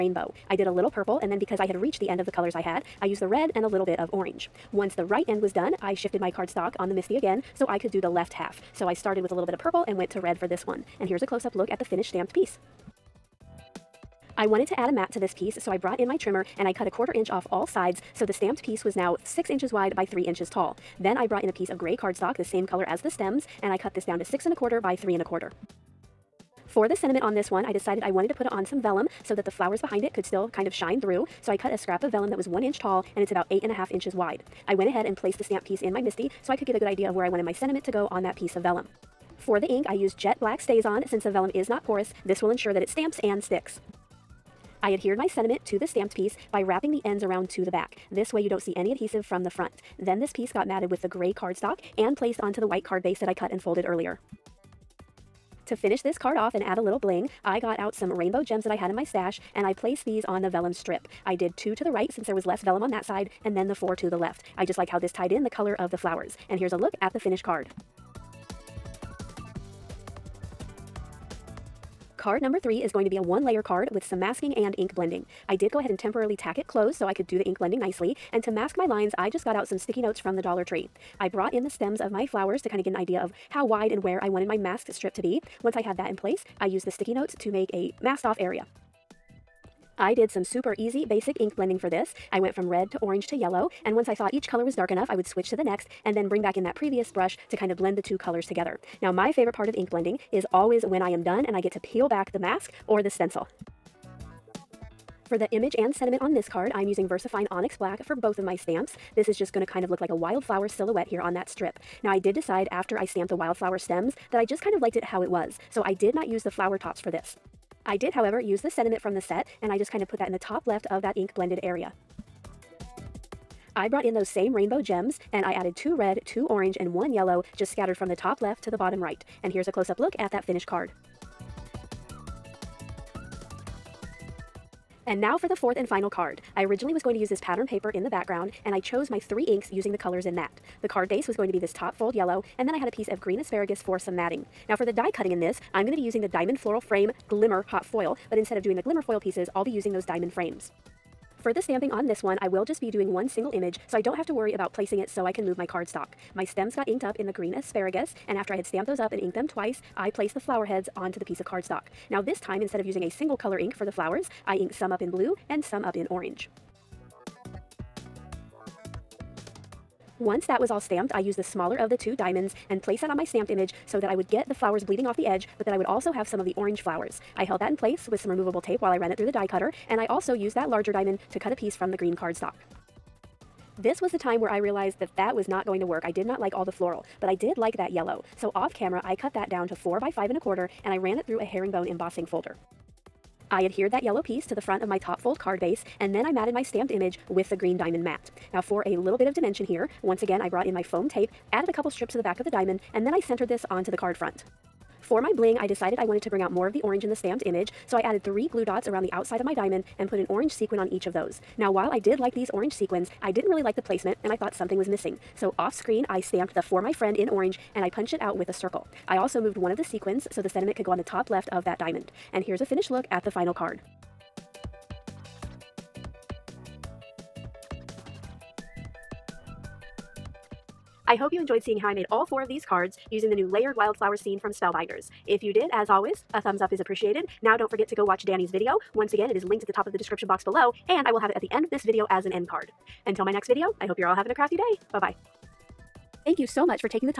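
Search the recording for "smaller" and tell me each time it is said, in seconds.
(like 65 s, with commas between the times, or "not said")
171 s.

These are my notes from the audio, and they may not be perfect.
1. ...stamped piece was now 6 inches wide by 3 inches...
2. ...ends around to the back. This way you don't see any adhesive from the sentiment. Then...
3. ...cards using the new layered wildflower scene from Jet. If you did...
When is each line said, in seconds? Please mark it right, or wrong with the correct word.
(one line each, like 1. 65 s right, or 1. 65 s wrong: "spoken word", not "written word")
1. 18 s right
2. 47 s wrong: "front", not "sentiment"
3. 232 s wrong: "Spellbinders", not "Jet".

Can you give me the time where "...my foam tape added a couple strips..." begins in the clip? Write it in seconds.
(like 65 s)
200 s.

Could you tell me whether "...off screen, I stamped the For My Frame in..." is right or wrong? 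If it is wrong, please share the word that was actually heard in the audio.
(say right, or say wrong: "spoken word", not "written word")
wrong: "Friend", not "Frame".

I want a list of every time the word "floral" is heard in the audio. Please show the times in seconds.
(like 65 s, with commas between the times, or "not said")
146 s, 186 s.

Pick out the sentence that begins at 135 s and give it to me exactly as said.
And now for the fourth and final card.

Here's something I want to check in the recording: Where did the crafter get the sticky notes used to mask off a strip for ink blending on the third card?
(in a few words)
Dollar Tree.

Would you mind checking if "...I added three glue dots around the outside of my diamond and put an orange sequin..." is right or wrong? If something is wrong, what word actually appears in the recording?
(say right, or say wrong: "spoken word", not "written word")
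right.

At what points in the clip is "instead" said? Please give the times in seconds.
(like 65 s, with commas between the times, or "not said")
148 s, 162 s.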